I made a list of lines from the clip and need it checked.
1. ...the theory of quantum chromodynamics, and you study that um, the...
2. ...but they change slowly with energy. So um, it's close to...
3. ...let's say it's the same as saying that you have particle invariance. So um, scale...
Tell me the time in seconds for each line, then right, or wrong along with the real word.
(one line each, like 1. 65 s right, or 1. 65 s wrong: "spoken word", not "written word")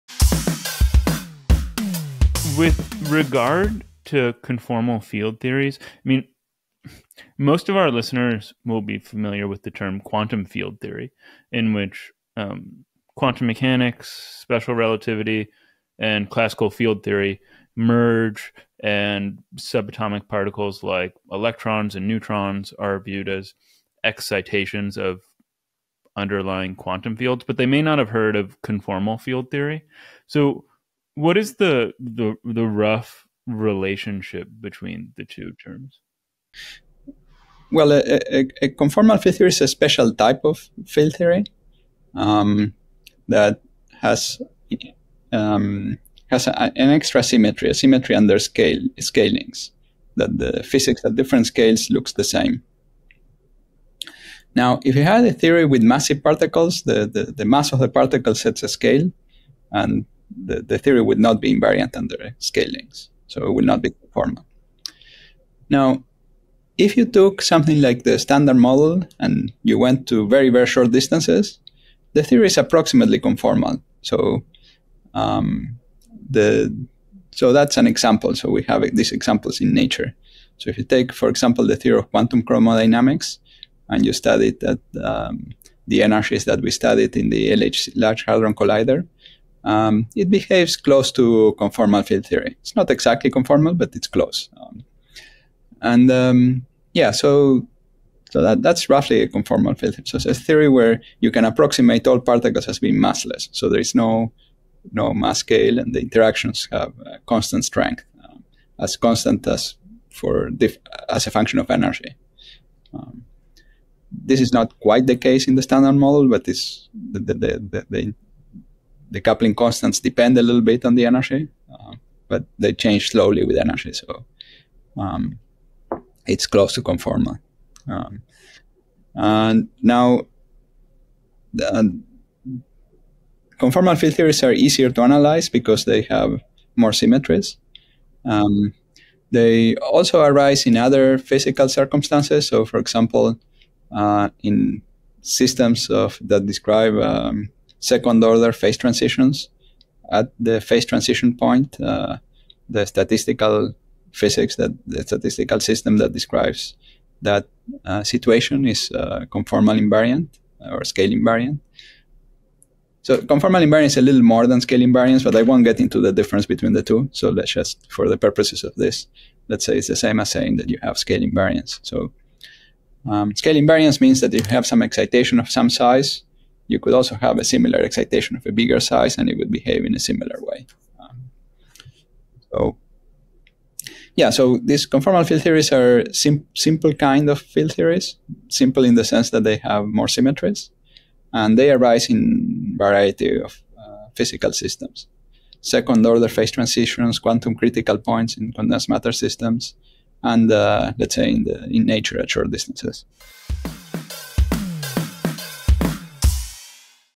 1. 81 s right
2. 122 s right
3. 169 s wrong: "scale", not "particle".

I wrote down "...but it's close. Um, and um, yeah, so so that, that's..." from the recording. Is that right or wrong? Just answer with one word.
right.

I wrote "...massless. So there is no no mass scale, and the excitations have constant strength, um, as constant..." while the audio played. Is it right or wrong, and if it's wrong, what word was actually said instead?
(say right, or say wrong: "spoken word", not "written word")
wrong: "interactions", not "excitations".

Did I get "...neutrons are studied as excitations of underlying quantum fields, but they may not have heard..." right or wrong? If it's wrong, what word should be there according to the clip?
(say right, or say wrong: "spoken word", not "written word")
wrong: "viewed", not "studied".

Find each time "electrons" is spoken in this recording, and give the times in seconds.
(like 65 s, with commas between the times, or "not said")
21 s.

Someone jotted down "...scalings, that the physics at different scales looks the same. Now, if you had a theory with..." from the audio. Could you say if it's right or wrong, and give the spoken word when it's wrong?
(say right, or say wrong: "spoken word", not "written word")
right.